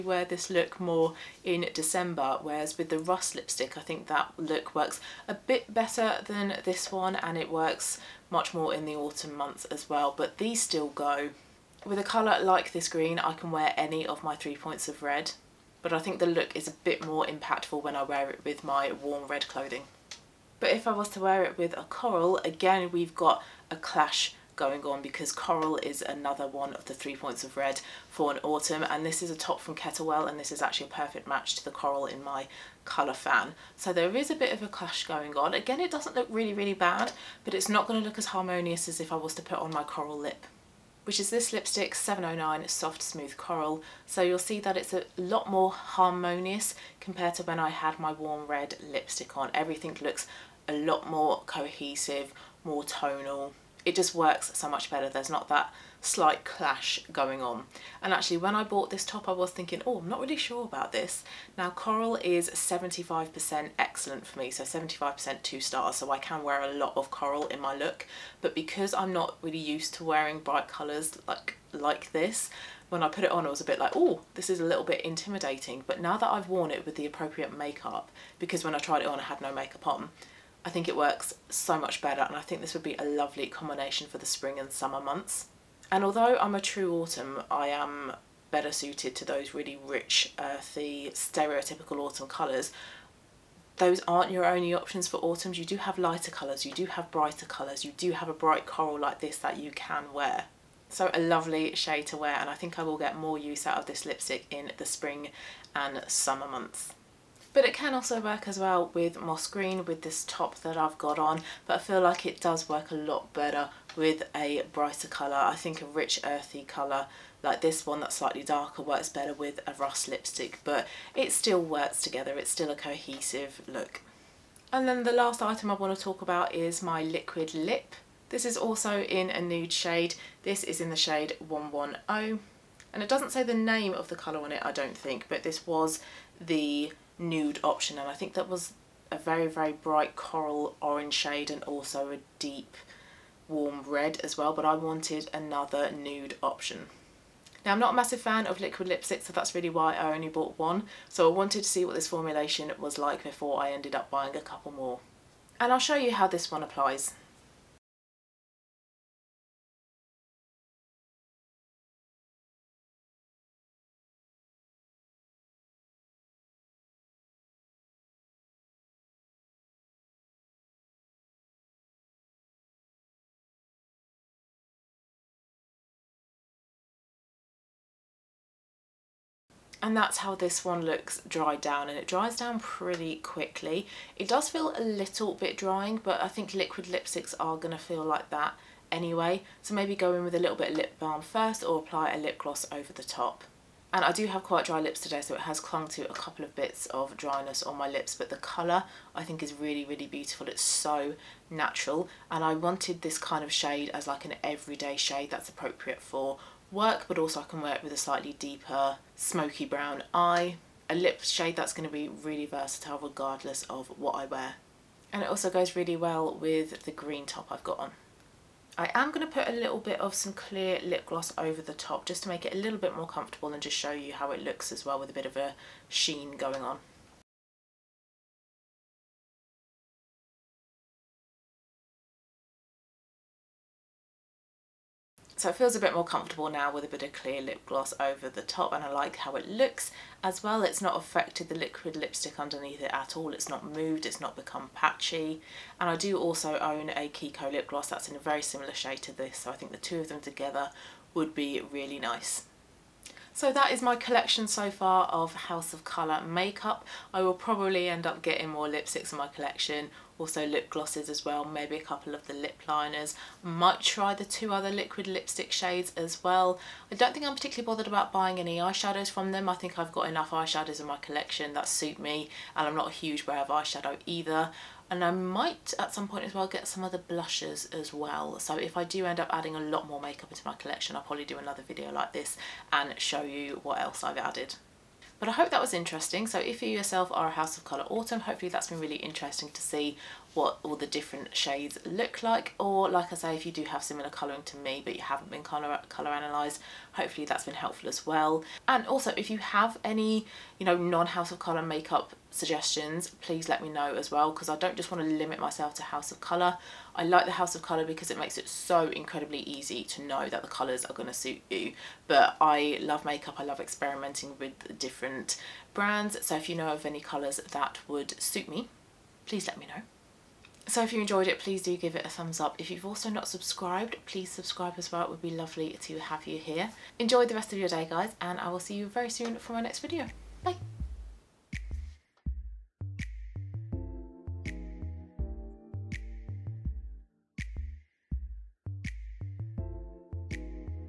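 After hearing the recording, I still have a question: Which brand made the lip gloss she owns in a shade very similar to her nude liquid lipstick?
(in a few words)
Kiko.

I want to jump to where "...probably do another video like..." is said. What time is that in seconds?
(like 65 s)
281 s.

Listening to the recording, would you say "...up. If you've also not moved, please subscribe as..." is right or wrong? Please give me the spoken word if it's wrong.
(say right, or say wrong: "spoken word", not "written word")
wrong: "subscribed", not "moved".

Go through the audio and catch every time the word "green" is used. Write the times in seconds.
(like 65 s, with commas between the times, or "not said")
12 s, 109 s, 216 s.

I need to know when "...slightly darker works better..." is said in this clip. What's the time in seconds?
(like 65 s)
118 s.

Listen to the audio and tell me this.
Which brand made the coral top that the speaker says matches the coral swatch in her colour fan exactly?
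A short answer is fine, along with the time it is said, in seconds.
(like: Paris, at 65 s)
Kettlewell, at 29 s.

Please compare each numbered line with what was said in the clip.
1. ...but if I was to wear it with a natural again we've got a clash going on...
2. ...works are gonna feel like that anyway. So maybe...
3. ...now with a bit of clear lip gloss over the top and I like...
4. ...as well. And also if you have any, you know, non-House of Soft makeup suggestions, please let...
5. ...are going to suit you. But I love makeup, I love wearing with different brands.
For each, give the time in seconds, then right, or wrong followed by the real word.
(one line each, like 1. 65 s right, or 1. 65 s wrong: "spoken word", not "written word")
1. 20 s wrong: "coral", not "natural"
2. 186 s wrong: "lipsticks", not "works"
3. 236 s right
4. 297 s wrong: "Colour", not "Soft"
5. 310 s wrong: "experimenting", not "wearing".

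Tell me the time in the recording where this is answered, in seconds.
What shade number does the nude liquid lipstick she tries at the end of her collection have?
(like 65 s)
131 s.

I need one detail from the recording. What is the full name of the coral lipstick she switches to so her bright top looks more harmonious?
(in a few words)
709 Soft Smooth Coral.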